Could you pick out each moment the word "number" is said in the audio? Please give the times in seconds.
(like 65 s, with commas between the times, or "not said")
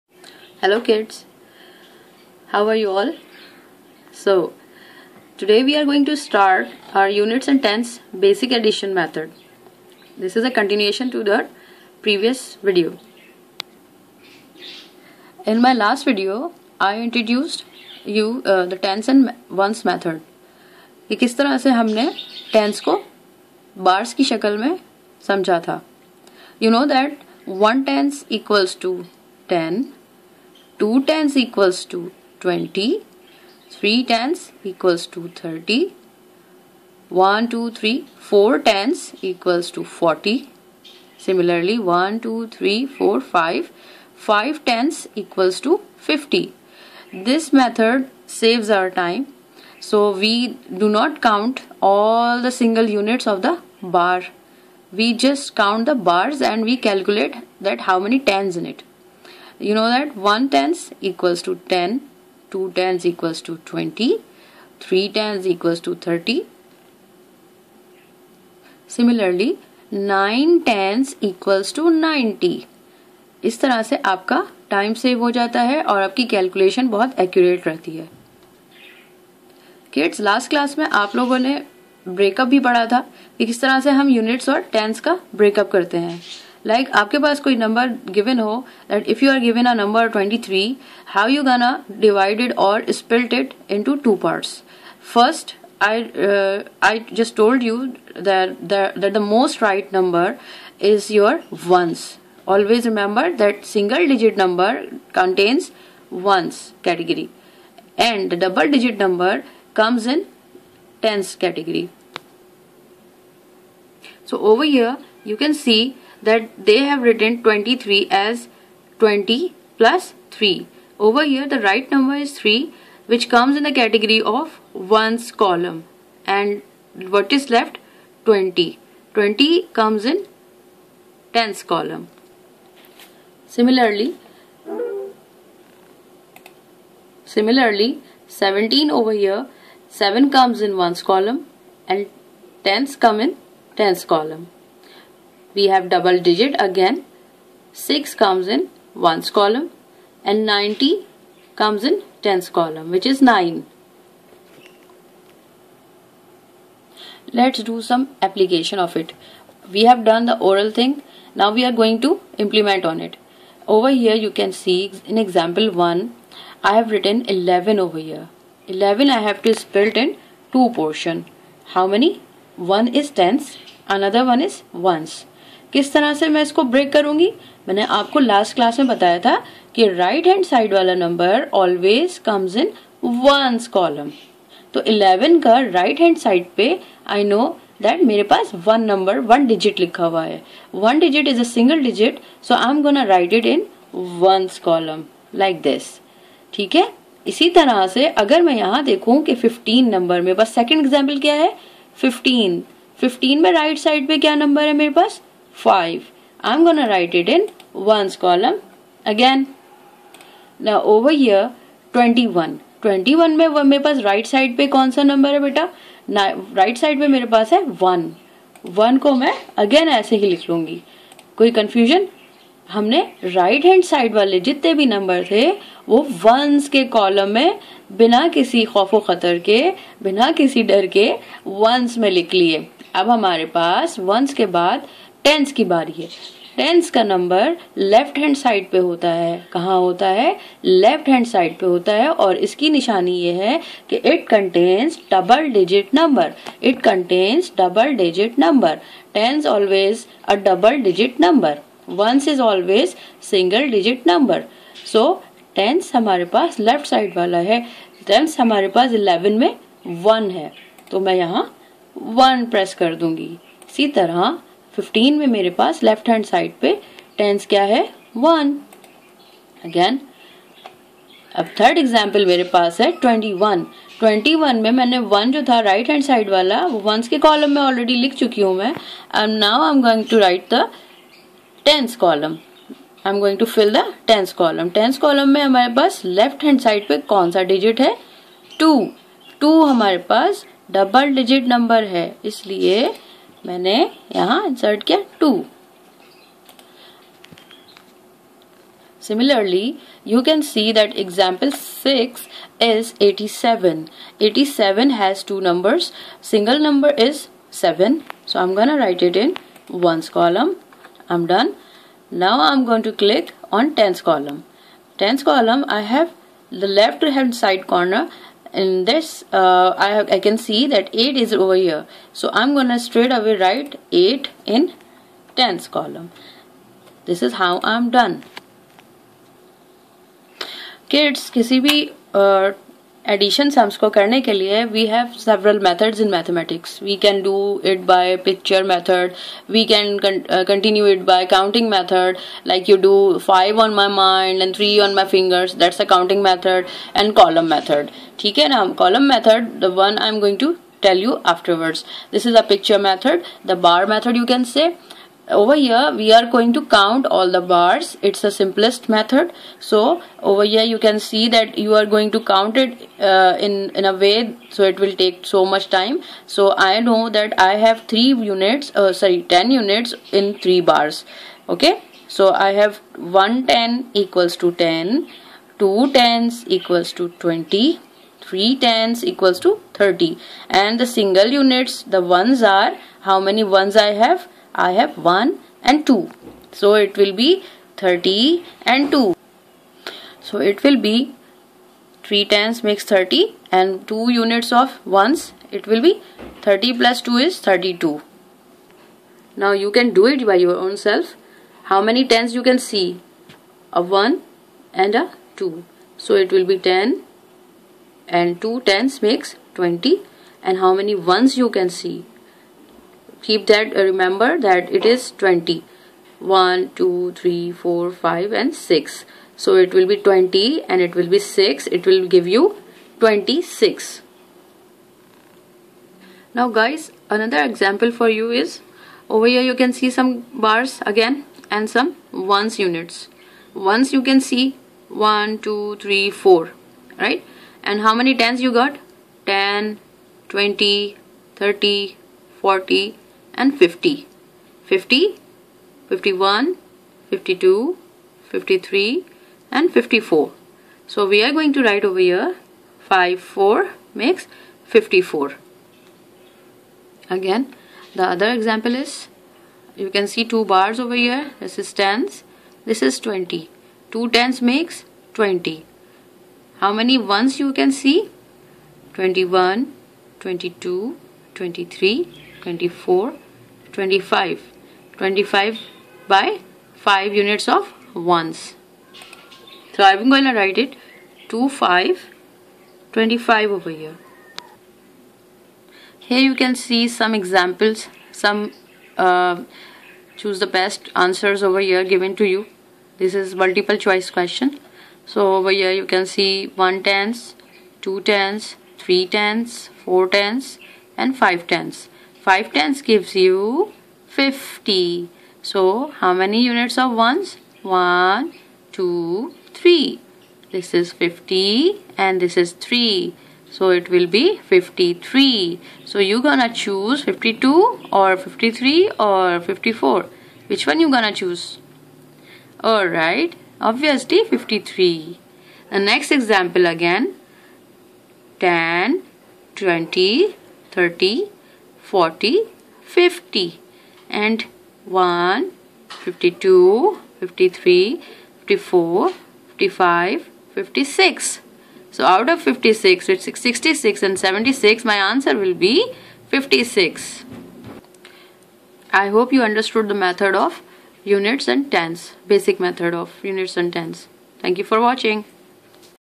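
121 s.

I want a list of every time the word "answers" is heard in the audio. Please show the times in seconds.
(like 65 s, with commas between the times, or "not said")
490 s, 544 s.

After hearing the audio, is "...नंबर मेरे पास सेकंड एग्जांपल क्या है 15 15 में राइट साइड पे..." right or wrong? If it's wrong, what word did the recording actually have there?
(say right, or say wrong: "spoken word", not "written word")
right.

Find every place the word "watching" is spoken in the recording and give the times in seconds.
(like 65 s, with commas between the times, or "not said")
554 s.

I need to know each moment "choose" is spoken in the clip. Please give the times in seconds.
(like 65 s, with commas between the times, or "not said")
490 s, 516 s, 521 s.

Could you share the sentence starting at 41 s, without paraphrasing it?
Similarly, 1, 2, 3, 4, 5, 5 tens equals to 50.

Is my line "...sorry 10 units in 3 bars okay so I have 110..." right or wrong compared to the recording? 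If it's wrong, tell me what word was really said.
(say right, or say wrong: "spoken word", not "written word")
right.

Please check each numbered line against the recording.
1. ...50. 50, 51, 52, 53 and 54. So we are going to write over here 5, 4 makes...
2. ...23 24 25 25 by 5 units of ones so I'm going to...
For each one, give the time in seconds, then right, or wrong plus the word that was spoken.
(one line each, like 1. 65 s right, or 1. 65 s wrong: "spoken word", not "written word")
1. 443 s right
2. 471 s right.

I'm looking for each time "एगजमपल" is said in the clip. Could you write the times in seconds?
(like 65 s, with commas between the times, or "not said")
271 s, 301 s.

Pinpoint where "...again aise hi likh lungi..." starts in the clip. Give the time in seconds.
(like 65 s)
219 s.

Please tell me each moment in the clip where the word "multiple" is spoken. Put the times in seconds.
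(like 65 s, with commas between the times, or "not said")
493 s.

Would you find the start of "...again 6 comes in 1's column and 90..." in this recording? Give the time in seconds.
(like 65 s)
146 s.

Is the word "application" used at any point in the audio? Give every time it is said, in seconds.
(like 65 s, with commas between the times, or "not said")
158 s.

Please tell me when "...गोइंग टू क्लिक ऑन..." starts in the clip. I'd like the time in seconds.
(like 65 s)
312 s.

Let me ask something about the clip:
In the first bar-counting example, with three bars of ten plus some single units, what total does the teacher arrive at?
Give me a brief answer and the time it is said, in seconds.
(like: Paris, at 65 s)
32, at 396 s.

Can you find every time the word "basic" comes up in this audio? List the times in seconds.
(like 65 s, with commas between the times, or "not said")
8 s, 552 s.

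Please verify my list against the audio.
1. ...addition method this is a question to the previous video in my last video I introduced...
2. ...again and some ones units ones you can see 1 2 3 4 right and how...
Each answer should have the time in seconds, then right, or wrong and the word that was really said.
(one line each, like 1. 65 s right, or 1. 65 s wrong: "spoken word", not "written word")
1. 8 s wrong: "continuation", not "question"
2. 430 s right.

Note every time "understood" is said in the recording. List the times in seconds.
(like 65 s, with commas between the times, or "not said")
549 s.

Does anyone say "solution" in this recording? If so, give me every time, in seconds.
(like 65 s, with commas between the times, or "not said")
not said.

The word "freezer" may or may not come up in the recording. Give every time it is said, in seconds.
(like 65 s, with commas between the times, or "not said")
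not said.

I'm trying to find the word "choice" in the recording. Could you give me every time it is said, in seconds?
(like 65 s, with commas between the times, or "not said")
493 s.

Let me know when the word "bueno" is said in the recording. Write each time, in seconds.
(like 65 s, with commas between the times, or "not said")
not said.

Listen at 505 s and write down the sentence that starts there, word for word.
So, how many units of ones?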